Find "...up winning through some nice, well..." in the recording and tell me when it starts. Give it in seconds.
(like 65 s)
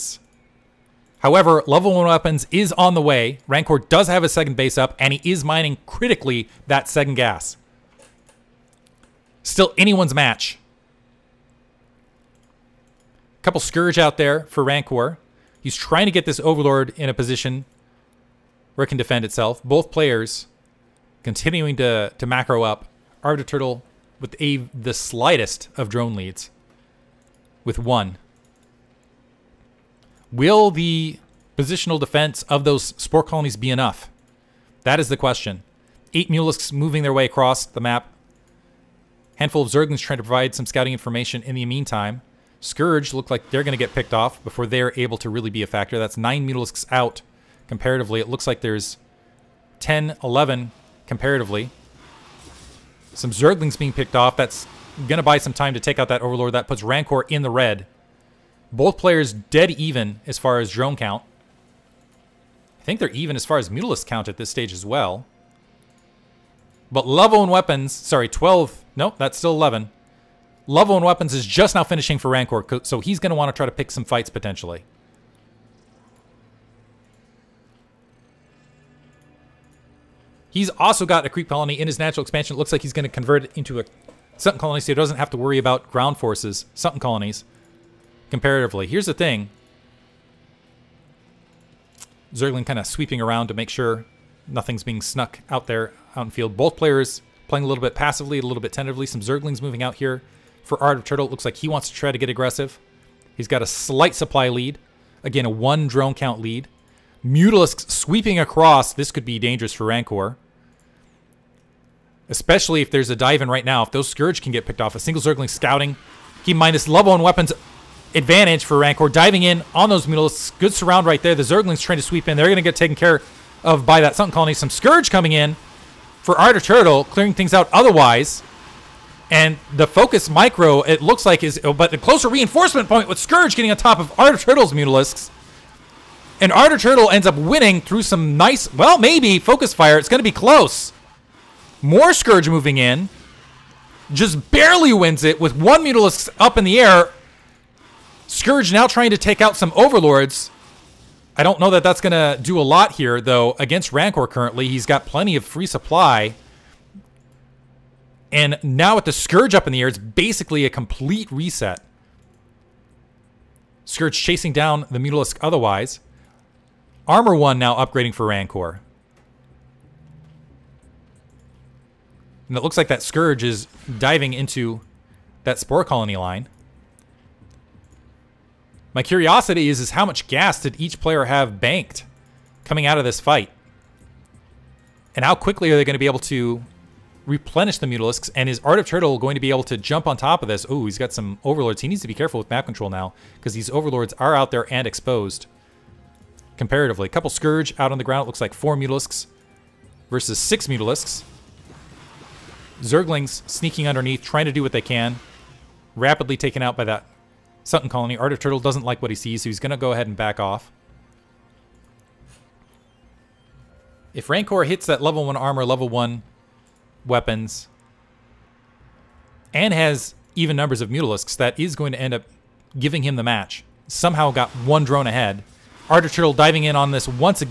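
137 s.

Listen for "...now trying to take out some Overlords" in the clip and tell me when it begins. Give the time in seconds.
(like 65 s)
148 s.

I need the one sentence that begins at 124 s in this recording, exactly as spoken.
Some Scourge coming in for Art Turtle.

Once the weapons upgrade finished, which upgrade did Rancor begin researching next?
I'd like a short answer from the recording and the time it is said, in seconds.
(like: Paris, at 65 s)
Armor 1, at 167 s.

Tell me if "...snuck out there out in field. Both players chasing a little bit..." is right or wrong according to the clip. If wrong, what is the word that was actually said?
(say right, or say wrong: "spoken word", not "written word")
wrong: "playing", not "chasing".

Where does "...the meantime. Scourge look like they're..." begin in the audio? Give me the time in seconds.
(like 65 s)
41 s.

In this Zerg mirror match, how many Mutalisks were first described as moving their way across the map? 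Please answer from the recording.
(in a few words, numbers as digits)
8.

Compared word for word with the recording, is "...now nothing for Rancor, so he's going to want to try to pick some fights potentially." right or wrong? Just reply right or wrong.
wrong.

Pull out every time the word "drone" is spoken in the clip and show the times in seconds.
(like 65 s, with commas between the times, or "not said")
25 s, 60 s, 105 s, 224 s.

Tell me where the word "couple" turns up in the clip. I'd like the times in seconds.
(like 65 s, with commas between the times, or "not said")
13 s, 197 s.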